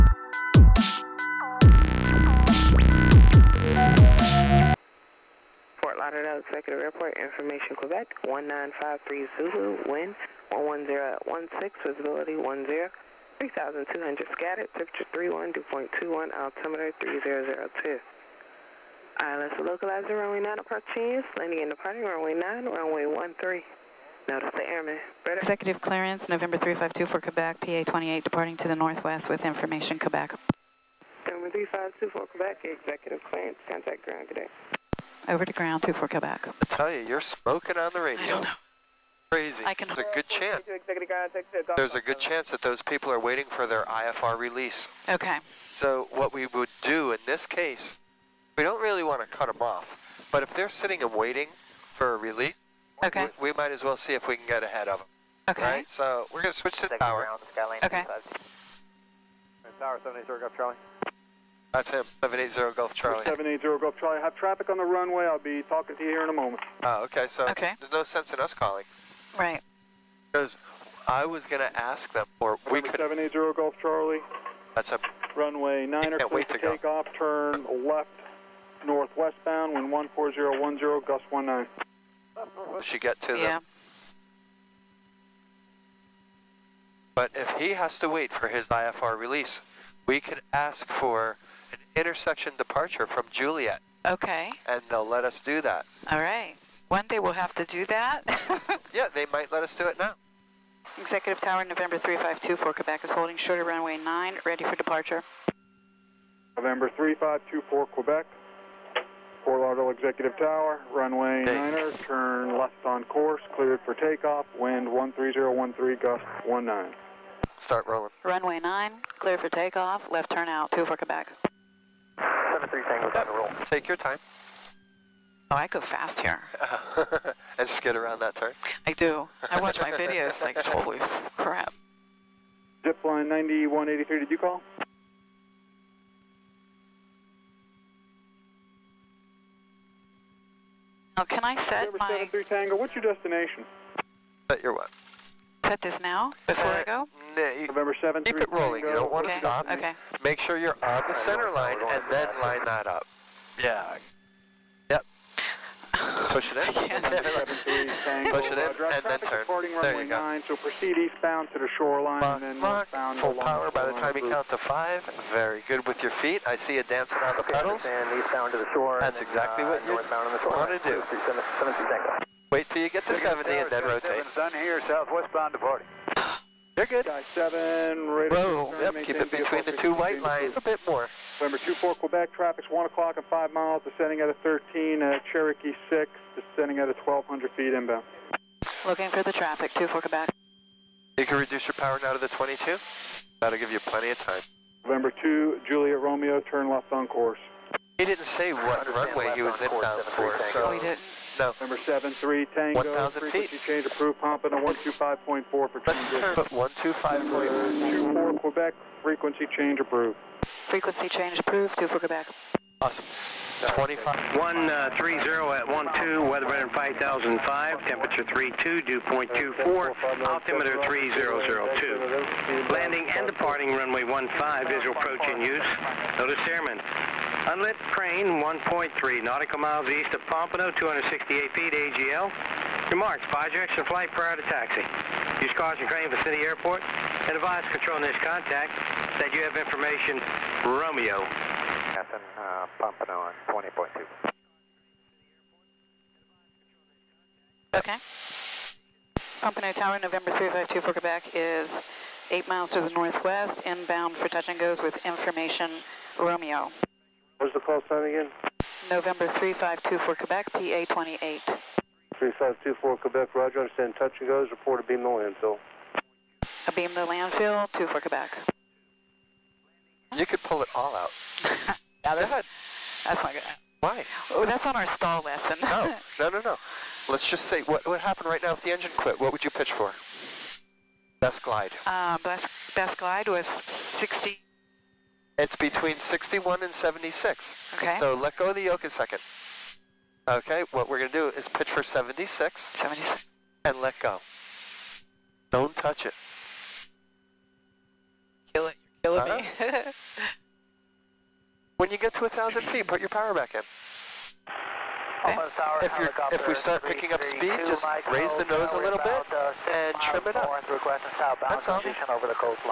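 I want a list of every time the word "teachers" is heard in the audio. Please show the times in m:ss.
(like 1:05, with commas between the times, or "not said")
not said.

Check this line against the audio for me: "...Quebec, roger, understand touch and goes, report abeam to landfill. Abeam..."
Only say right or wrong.
right.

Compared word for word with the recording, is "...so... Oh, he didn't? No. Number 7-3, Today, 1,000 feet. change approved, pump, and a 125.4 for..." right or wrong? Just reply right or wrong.
wrong.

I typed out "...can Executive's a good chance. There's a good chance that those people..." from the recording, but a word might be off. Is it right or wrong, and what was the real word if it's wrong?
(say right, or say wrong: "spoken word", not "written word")
wrong: "There", not "Executive".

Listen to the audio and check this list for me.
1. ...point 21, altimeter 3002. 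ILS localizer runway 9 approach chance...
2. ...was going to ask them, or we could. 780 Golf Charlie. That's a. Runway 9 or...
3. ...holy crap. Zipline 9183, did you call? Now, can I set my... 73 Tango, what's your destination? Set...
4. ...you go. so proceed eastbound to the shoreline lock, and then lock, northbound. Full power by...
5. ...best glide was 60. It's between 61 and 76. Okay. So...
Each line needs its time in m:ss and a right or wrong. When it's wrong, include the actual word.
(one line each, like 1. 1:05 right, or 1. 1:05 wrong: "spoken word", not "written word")
1. 0:15 right
2. 1:11 right
3. 2:10 right
4. 2:40 right
5. 4:42 right.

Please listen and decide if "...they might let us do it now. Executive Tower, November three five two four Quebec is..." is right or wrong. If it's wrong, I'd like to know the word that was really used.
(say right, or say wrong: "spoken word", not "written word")
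right.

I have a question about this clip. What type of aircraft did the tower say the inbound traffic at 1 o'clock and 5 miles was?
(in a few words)
Cherokee 6.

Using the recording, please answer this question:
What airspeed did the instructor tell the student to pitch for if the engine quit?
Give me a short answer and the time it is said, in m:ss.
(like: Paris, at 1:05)
76, at 4:51.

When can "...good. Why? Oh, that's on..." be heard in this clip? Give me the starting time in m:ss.
4:33.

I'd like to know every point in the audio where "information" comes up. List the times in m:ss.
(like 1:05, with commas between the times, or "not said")
0:07, 0:29, 3:59, 4:15.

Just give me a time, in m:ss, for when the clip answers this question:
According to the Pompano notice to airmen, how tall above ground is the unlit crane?
3:50.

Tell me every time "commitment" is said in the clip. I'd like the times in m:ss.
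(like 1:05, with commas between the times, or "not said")
not said.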